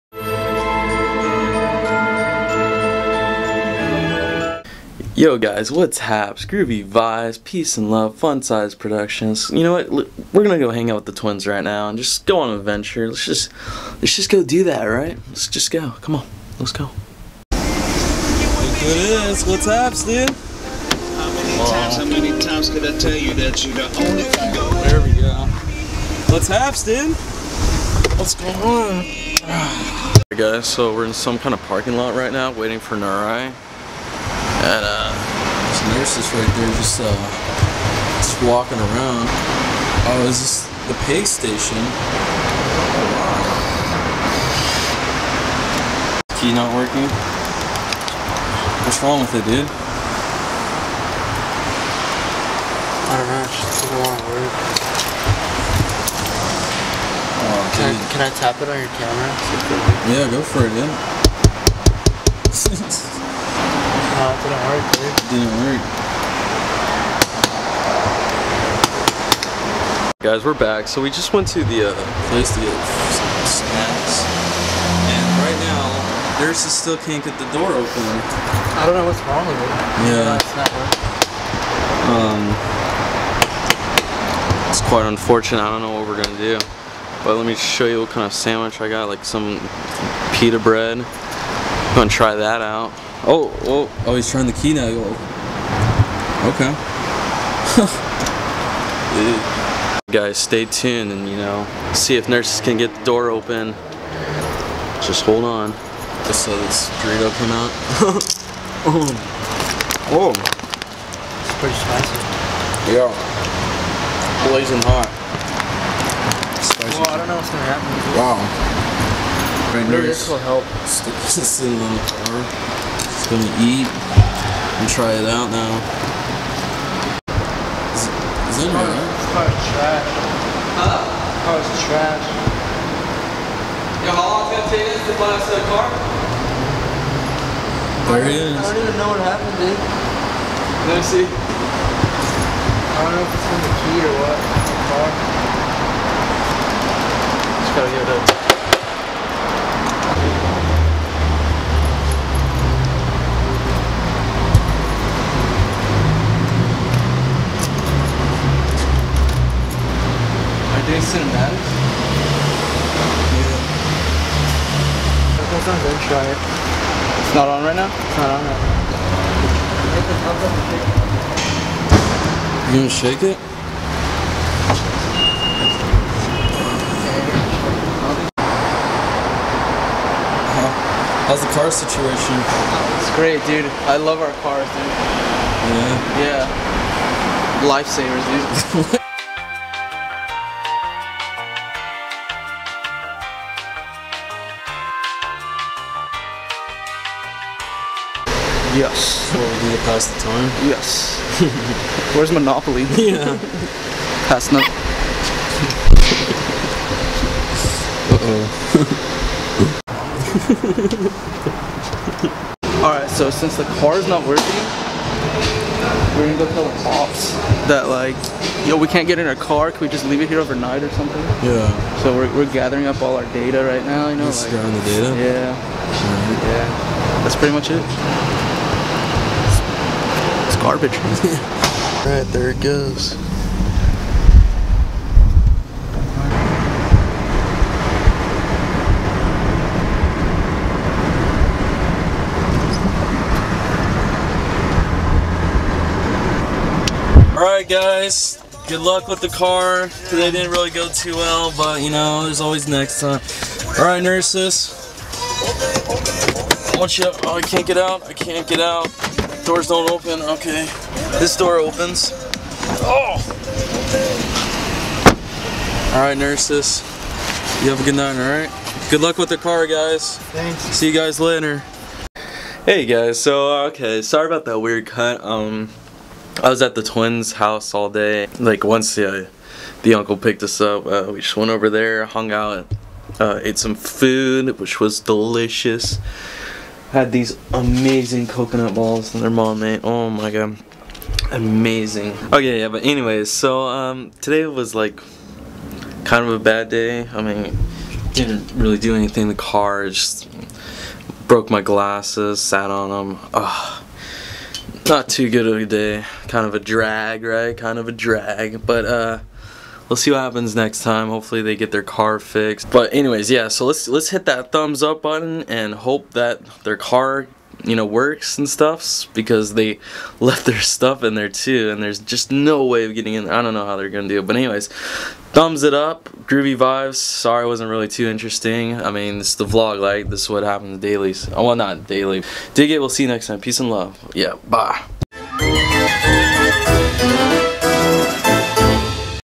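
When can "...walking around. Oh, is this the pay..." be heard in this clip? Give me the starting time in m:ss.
0:38.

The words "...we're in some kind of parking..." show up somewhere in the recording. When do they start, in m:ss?
0:30.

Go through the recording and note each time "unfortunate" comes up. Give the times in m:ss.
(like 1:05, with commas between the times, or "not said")
1:25.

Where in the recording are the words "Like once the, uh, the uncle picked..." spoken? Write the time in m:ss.
4:38.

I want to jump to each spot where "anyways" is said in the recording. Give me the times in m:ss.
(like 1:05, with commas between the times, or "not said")
4:52, 5:12, 5:24.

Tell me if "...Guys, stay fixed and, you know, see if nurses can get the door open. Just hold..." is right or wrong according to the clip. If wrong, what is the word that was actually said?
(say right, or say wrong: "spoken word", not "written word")
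wrong: "tuned", not "fixed".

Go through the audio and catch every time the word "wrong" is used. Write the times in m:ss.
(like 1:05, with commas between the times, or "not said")
0:49, 1:19.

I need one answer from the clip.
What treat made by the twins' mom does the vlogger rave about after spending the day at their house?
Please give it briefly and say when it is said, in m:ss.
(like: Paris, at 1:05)
coconut balls, at 4:48.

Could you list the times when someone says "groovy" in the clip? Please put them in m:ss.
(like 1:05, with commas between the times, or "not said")
0:06, 5:26.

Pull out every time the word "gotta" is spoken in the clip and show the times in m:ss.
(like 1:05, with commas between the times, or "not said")
2:27.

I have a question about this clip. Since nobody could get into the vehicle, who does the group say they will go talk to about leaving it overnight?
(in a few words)
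the cops.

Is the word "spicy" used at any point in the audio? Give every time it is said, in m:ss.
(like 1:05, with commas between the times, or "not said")
1:51, 1:56.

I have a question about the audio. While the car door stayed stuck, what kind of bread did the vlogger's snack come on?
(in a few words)
pita bread.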